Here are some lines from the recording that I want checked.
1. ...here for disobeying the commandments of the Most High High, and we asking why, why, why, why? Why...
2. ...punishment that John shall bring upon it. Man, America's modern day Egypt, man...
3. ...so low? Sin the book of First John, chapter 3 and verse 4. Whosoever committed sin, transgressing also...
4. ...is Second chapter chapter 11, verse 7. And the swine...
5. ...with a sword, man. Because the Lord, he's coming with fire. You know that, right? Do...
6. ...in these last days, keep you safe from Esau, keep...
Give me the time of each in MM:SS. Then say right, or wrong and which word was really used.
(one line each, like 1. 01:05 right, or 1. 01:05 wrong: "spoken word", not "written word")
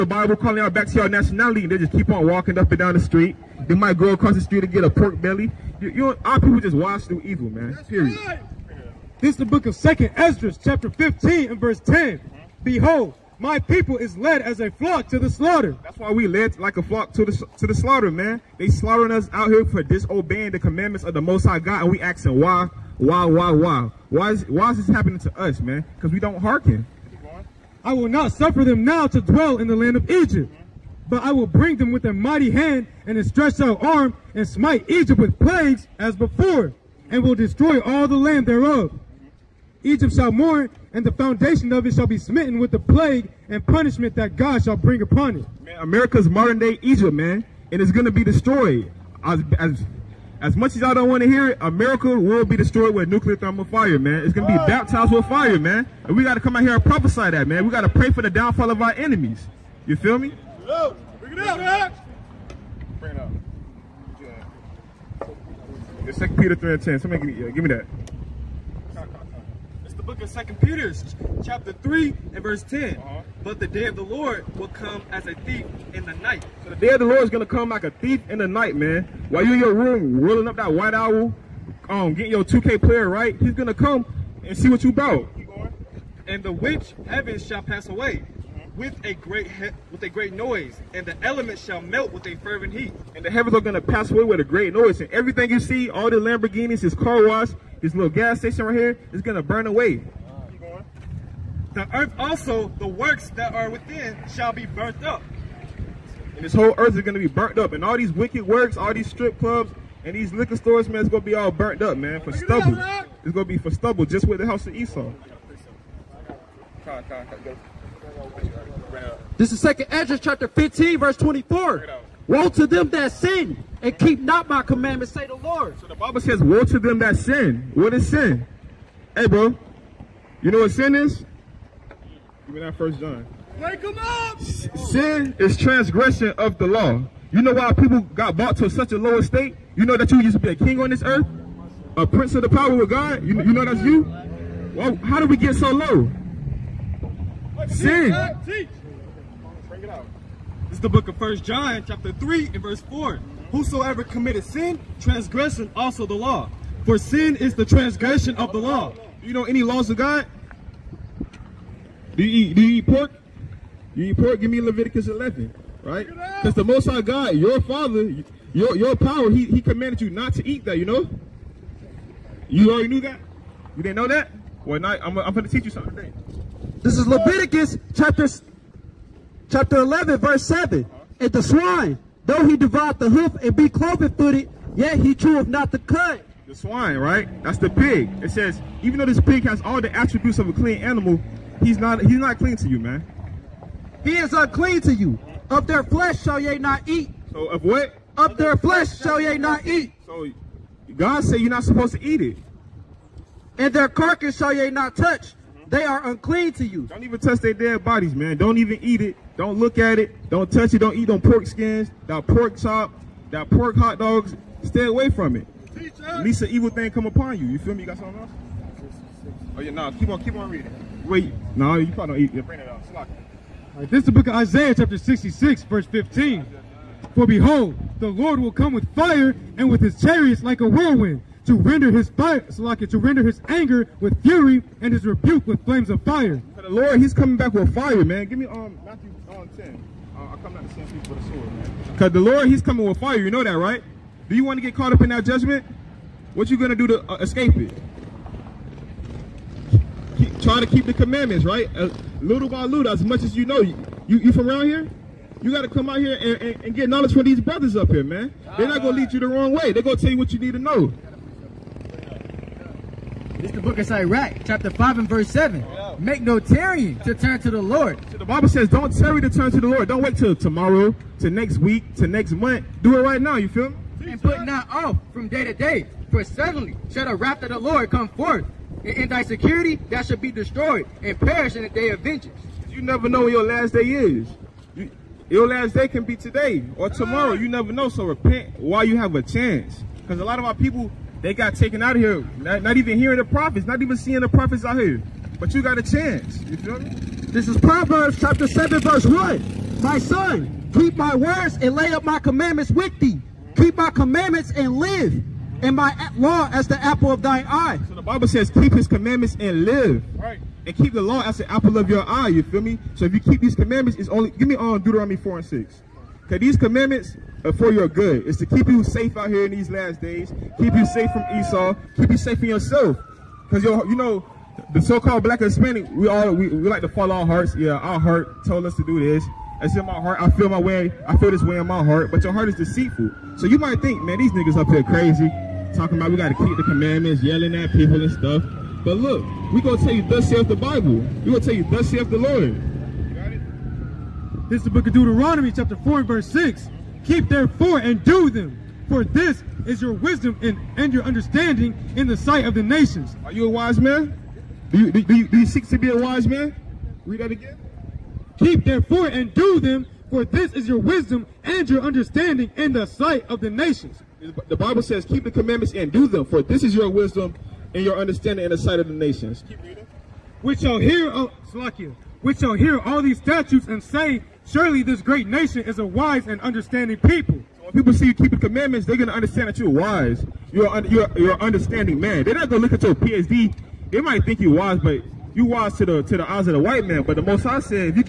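1. 00:19 wrong: "God", not "High"
2. 00:43 wrong: "God", not "John"
3. 02:25 right
4. 02:56 wrong: "Leviticus", not "Second"
5. 04:01 right
6. 05:19 right.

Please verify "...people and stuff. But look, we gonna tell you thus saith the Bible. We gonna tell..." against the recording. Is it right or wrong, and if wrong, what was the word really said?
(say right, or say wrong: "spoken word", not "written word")
right.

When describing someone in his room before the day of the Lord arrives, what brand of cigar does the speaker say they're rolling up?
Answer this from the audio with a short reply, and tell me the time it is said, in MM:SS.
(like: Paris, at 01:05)
White Owl, at 01:20.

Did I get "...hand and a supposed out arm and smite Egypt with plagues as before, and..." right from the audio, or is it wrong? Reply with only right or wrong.
wrong.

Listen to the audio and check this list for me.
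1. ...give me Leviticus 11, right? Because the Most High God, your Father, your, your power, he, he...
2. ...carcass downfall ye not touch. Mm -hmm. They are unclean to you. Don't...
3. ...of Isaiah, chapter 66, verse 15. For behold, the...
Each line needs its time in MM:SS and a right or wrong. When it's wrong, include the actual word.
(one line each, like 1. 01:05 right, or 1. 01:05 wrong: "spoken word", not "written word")
1. 02:44 right
2. 03:23 wrong: "shall", not "downfall"
3. 03:44 right.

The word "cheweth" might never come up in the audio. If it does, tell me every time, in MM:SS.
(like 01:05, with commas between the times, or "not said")
03:05.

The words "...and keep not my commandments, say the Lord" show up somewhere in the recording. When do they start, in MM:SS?
02:03.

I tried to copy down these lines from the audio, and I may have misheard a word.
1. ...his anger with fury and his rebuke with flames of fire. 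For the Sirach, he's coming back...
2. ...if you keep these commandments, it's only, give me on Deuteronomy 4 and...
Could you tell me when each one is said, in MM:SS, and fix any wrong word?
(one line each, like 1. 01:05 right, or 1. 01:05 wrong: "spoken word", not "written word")
1. 03:53 wrong: "Lord", not "Sirach"
2. 05:13 right.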